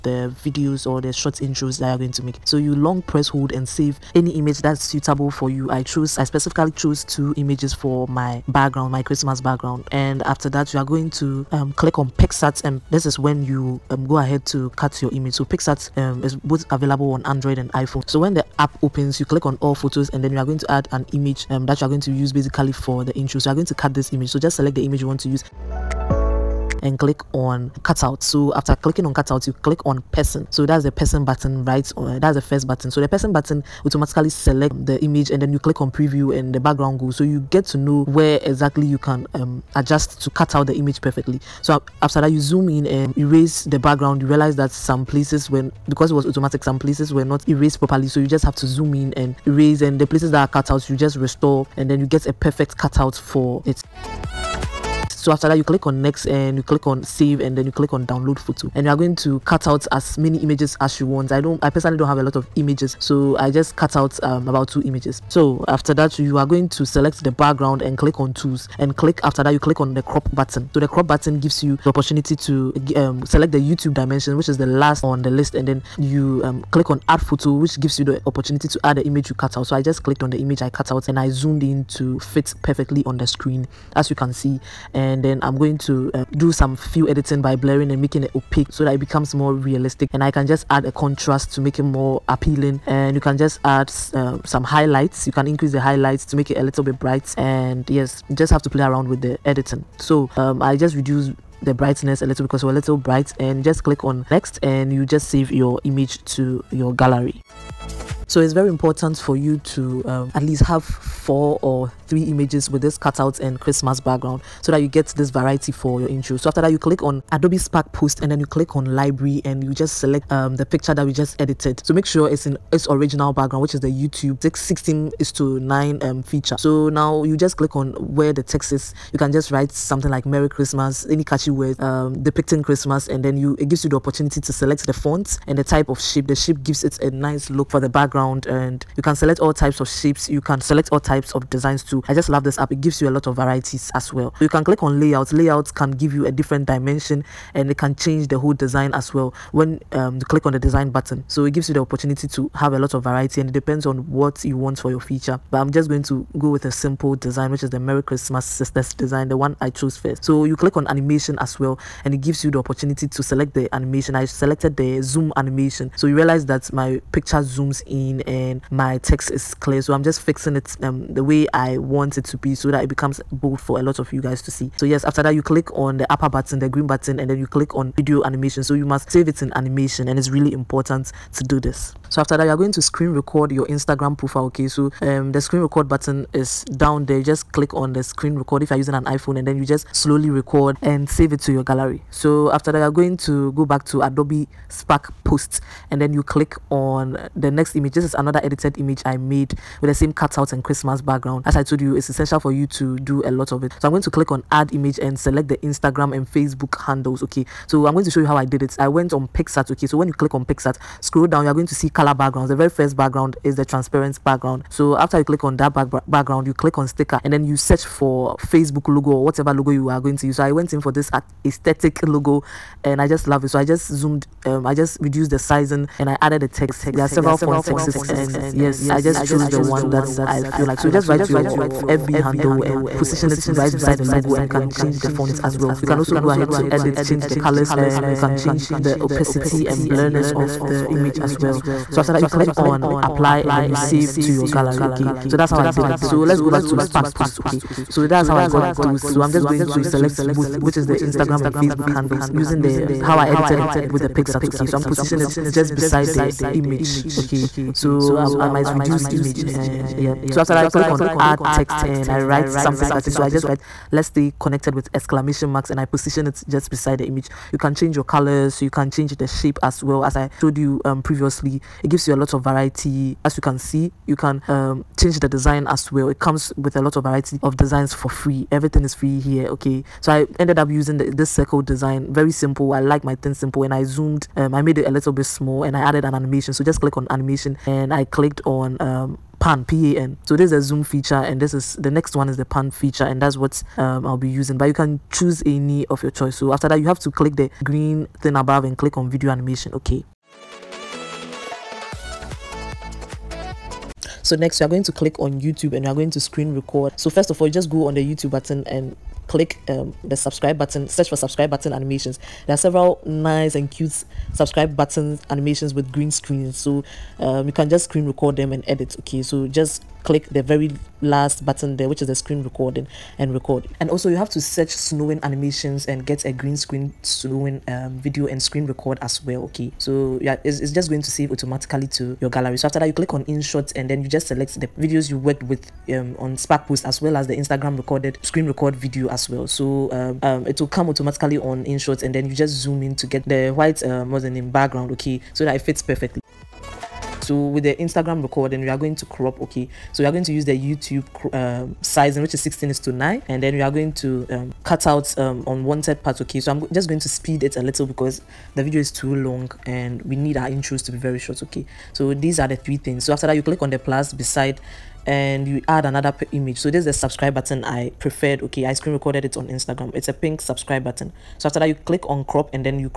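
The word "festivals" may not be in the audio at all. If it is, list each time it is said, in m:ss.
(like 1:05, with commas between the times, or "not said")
not said.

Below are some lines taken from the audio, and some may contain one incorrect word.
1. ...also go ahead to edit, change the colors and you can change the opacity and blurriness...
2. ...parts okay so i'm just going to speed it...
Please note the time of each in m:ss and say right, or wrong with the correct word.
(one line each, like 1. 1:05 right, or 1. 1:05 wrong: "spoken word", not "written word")
1. 3:55 right
2. 5:56 right.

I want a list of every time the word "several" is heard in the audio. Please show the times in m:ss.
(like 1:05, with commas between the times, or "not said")
3:47, 5:12.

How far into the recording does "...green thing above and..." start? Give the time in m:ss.
4:57.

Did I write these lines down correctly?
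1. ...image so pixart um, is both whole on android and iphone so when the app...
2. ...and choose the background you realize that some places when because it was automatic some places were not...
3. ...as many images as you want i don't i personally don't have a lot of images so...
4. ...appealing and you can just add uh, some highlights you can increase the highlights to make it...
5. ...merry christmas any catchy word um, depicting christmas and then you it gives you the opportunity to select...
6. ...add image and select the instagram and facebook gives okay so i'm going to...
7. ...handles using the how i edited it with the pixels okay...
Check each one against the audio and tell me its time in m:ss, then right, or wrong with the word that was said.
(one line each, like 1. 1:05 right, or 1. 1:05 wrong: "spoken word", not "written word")
1. 0:15 wrong: "available", not "whole"
2. 0:42 wrong: "erase", not "choose"
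3. 0:59 right
4. 1:32 right
5. 2:10 right
6. 3:24 wrong: "handles", not "gives"
7. 4:11 right.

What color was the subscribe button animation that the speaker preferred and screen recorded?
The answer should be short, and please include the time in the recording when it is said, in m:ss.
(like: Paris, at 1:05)
Pink, at 6:10.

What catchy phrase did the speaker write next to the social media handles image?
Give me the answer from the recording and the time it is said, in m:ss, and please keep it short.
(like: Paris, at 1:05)
Let's stay connected, at 4:23.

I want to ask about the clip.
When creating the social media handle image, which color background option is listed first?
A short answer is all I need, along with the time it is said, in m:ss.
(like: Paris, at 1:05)
Transparent, at 3:33.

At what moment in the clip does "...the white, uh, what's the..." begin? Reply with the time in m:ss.
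5:43.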